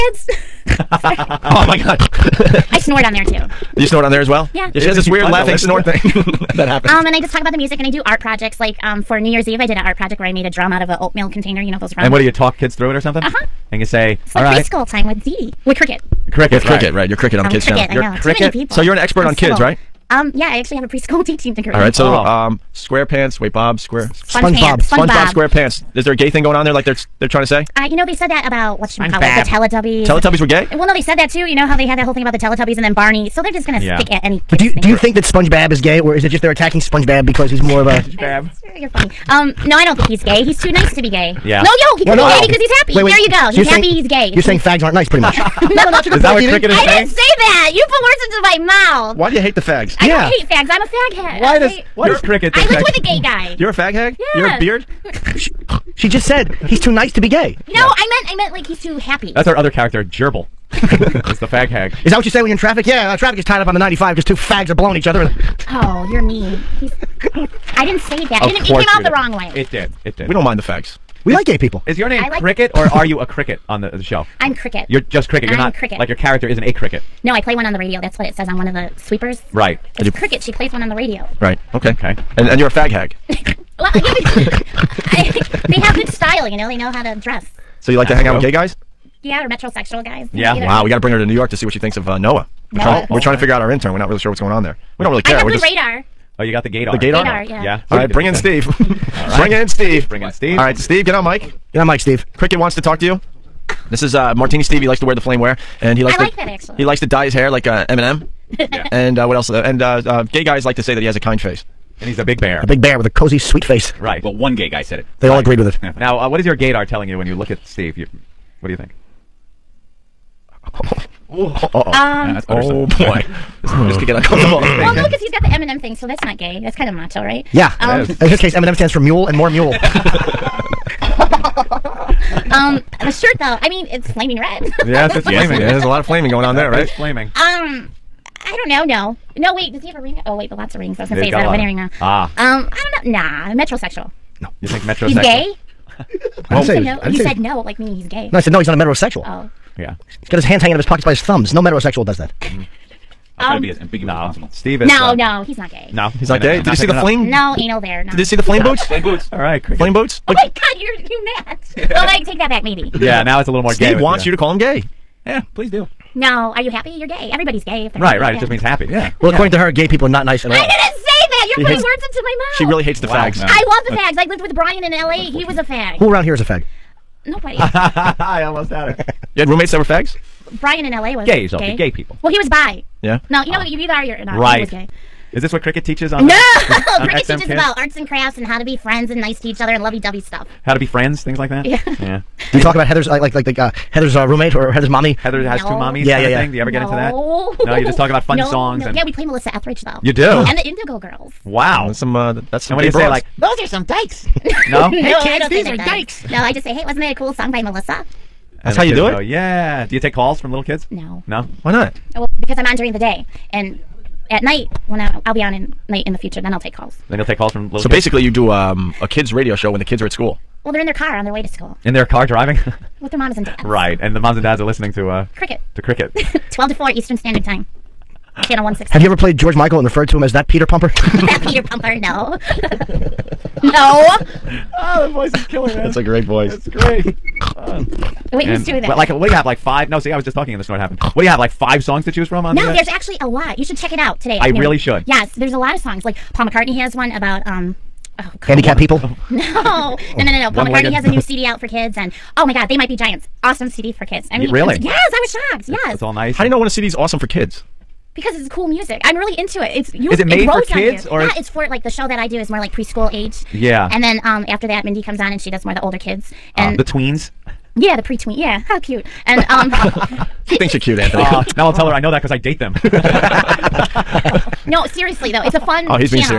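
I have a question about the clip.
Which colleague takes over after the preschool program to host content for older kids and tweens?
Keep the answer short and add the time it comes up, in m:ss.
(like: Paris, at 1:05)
Mindy, at 4:24.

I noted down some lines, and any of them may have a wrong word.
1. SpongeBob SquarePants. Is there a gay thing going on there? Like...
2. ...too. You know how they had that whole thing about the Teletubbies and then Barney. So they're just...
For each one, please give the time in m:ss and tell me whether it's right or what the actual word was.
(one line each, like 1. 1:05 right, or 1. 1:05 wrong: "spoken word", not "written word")
1. 0:25 right
2. 0:31 right.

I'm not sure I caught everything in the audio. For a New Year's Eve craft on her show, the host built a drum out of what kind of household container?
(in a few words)
Oatmeal container.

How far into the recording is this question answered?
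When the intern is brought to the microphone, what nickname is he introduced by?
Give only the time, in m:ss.
1:44.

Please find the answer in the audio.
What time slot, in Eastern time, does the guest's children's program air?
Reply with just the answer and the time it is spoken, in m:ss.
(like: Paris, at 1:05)
12 to 4, at 3:46.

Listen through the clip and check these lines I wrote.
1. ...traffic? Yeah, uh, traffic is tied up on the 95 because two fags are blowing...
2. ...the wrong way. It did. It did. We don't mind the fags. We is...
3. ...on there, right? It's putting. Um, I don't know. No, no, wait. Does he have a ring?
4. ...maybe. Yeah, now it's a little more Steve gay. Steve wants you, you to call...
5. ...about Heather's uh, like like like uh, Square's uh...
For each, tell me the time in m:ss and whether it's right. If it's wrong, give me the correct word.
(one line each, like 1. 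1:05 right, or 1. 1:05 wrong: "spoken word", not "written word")
1. 1:02 right
2. 1:09 right
3. 2:16 wrong: "flaming", not "putting"
4. 2:42 right
5. 3:12 wrong: "Heather", not "Square".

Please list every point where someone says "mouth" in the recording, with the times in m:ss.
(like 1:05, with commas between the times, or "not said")
0:48, 2:52.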